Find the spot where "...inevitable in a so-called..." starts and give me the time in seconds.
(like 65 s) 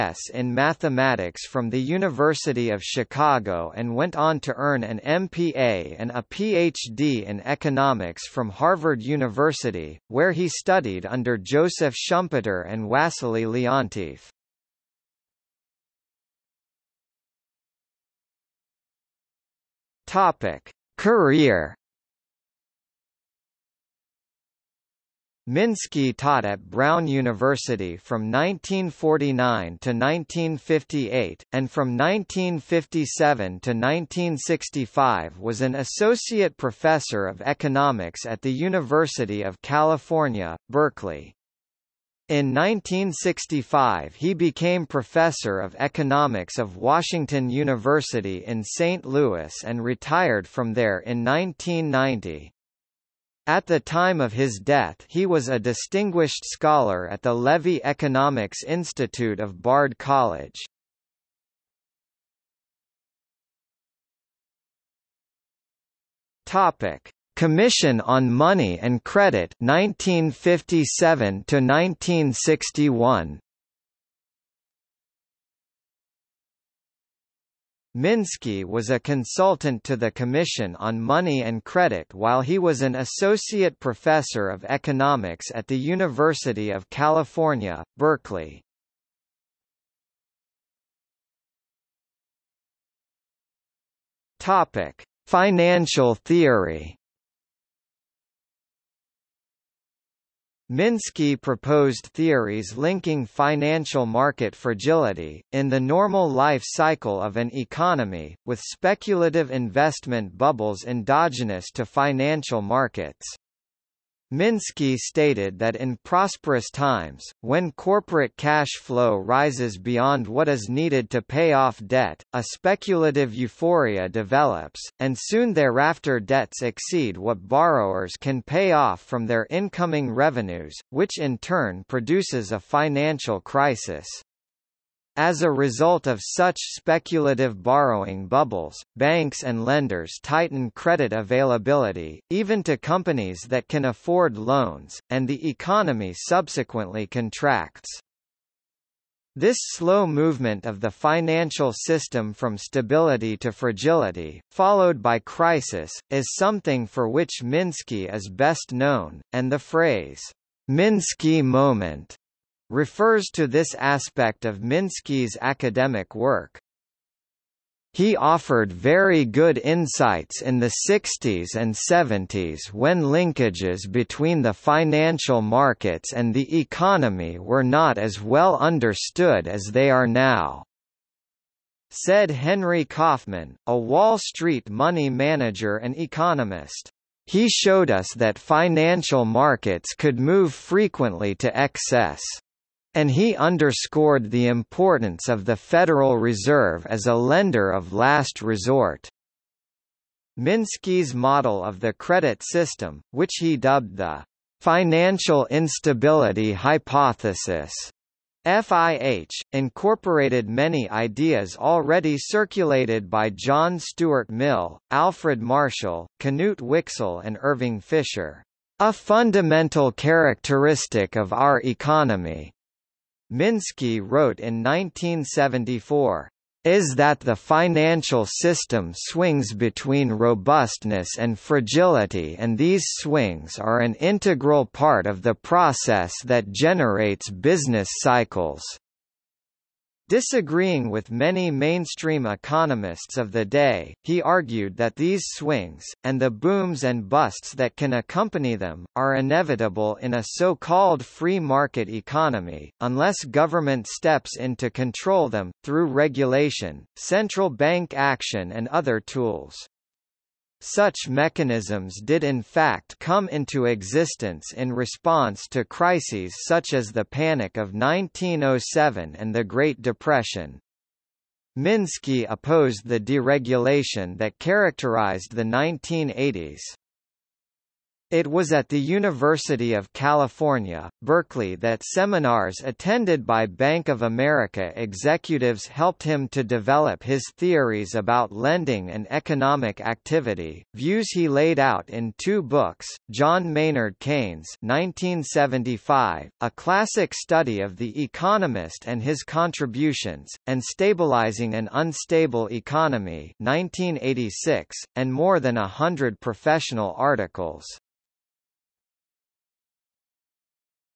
249 s.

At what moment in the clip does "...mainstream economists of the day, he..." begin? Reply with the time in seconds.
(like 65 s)
241 s.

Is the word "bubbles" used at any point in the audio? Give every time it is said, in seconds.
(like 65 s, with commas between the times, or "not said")
110 s, 138 s.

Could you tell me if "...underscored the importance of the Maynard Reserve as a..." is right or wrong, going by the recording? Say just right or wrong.
wrong.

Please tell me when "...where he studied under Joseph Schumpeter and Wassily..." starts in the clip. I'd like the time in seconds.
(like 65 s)
10 s.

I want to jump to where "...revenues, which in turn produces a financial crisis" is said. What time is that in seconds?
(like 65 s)
130 s.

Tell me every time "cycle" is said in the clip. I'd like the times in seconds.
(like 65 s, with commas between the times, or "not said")
106 s, 238 s.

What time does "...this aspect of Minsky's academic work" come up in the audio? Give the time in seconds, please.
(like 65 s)
163 s.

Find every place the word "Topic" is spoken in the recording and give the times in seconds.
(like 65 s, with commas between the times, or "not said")
66 s, 94 s.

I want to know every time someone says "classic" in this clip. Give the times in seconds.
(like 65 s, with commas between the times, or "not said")
296 s.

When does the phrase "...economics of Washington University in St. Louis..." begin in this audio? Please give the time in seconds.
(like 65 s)
45 s.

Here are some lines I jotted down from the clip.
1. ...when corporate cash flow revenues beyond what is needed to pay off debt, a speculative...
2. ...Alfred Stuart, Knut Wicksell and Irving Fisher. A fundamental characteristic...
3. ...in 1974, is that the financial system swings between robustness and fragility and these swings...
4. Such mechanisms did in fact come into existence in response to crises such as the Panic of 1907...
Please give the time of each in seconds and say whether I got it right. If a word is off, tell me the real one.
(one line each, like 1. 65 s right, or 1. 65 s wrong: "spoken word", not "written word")
1. 117 s wrong: "rises", not "revenues"
2. 214 s wrong: "Marshall", not "Stuart"
3. 224 s right
4. 260 s right.